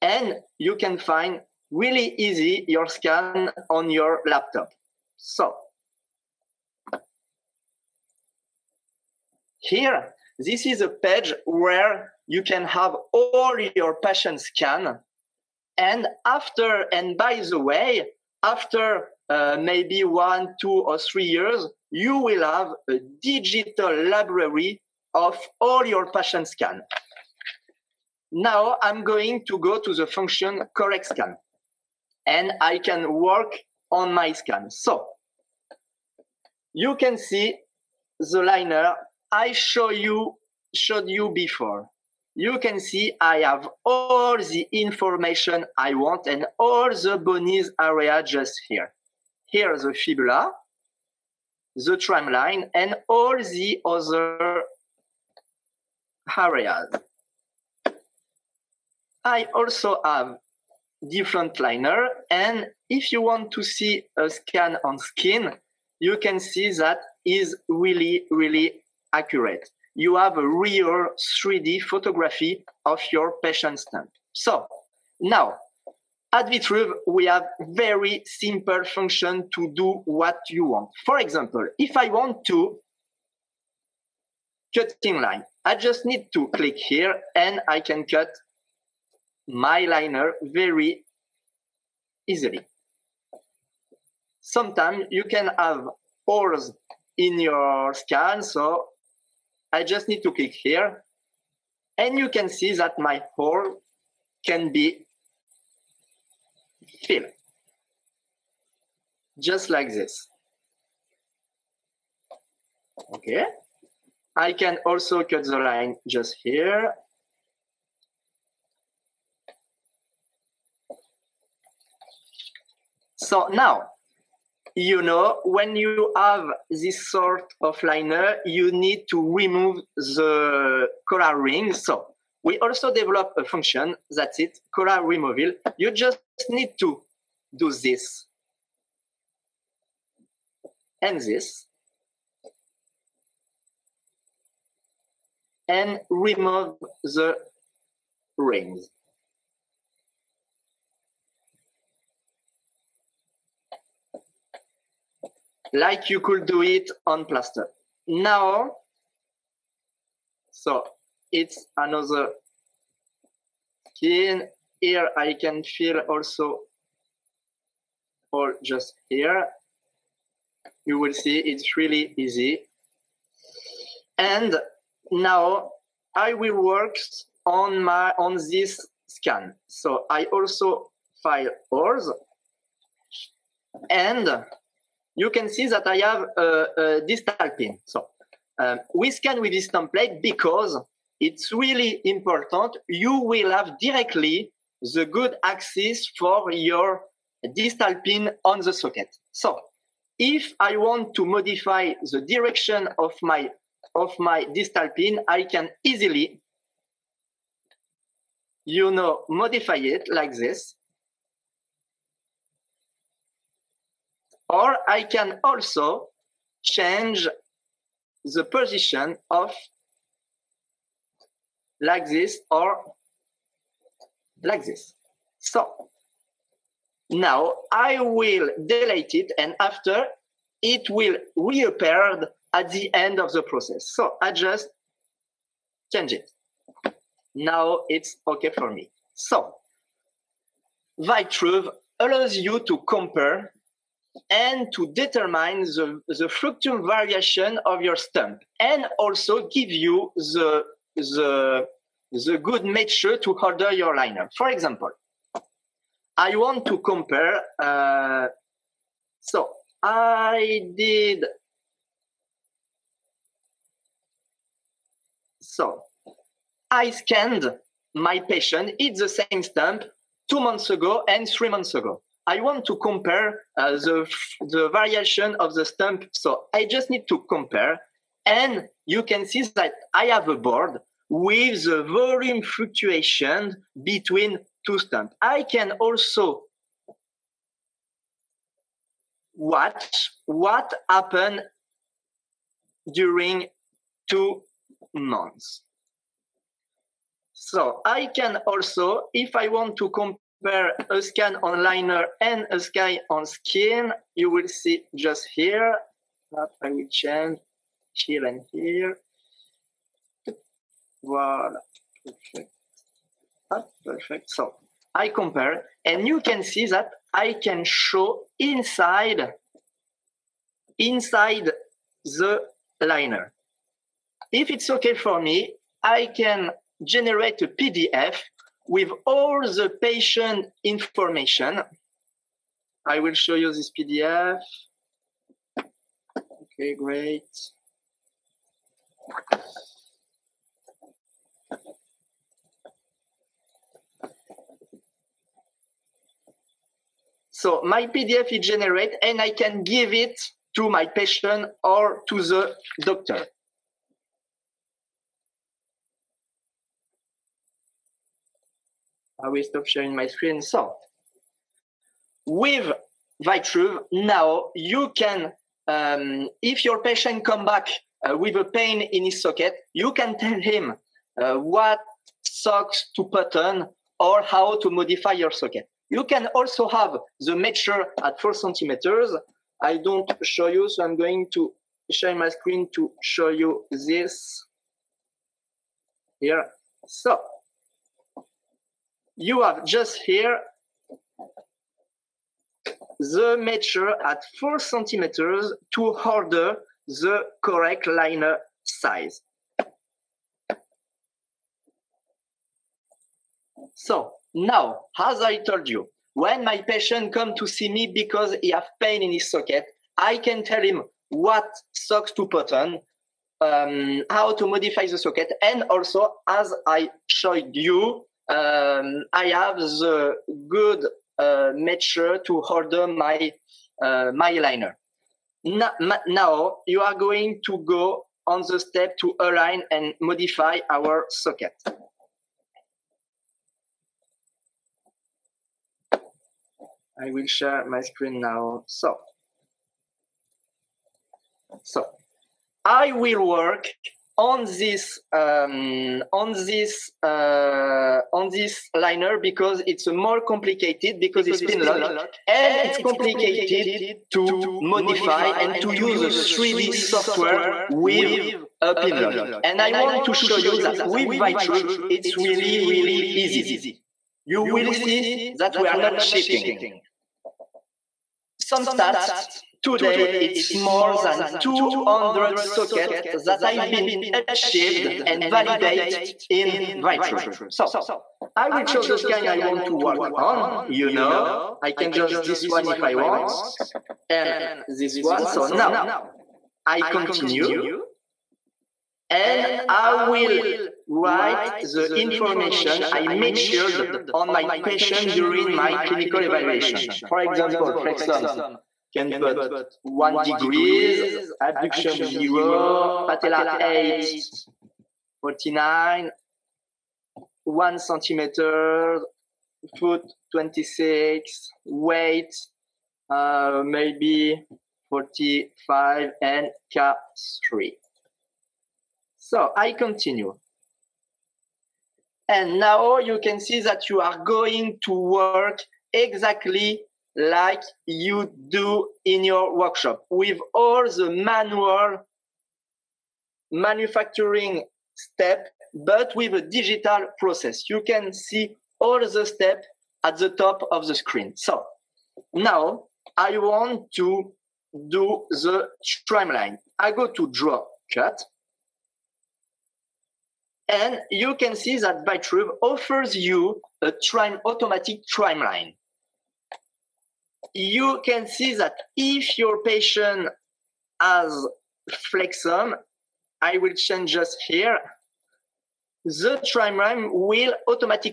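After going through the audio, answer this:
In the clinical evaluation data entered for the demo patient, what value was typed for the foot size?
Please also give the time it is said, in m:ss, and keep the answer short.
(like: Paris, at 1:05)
26, at 8:30.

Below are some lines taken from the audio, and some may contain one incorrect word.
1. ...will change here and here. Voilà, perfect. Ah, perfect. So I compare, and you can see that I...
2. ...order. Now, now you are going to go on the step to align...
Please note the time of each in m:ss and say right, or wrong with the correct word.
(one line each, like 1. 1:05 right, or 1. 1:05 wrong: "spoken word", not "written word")
1. 5:06 right
2. 7:04 wrong: "liner", not "order".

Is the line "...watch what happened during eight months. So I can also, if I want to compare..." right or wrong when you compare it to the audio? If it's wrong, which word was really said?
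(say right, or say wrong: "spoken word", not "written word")
wrong: "two", not "eight".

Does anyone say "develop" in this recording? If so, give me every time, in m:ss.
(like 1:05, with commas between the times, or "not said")
2:12.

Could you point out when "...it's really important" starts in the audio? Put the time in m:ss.
3:11.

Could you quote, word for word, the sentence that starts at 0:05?
So Here, this is a page where you can have all your patient scan.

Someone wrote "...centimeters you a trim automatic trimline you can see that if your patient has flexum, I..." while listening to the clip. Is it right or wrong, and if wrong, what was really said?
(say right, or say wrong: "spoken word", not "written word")
wrong: "offers", not "centimeters".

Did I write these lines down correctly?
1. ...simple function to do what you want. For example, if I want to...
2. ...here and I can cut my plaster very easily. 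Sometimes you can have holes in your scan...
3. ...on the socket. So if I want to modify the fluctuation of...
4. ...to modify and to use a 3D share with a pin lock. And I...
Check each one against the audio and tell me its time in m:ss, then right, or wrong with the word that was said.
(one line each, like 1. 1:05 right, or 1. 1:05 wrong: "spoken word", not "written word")
1. 1:18 right
2. 1:26 wrong: "liner", not "plaster"
3. 3:18 wrong: "direction", not "fluctuation"
4. 7:34 wrong: "software", not "share".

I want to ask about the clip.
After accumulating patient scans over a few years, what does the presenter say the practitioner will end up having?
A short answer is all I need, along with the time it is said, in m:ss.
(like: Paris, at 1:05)
digital library, at 0:23.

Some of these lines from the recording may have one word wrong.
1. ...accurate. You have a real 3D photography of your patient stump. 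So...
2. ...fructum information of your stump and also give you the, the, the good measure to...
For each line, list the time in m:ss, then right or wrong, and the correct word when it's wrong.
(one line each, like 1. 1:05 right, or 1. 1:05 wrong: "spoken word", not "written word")
1. 1:09 right
2. 4:06 wrong: "variation", not "information".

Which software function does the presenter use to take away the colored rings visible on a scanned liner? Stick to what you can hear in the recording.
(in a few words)
color removal.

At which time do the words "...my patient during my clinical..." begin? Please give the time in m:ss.
8:14.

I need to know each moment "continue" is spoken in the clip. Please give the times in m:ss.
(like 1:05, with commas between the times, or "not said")
8:06, 8:39.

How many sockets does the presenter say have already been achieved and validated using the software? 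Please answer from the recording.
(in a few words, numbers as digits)
more than 200.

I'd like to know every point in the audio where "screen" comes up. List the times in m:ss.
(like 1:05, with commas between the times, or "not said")
6:00, 6:22, 7:17, 9:00.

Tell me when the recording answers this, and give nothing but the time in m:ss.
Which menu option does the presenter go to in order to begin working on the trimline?
9:07.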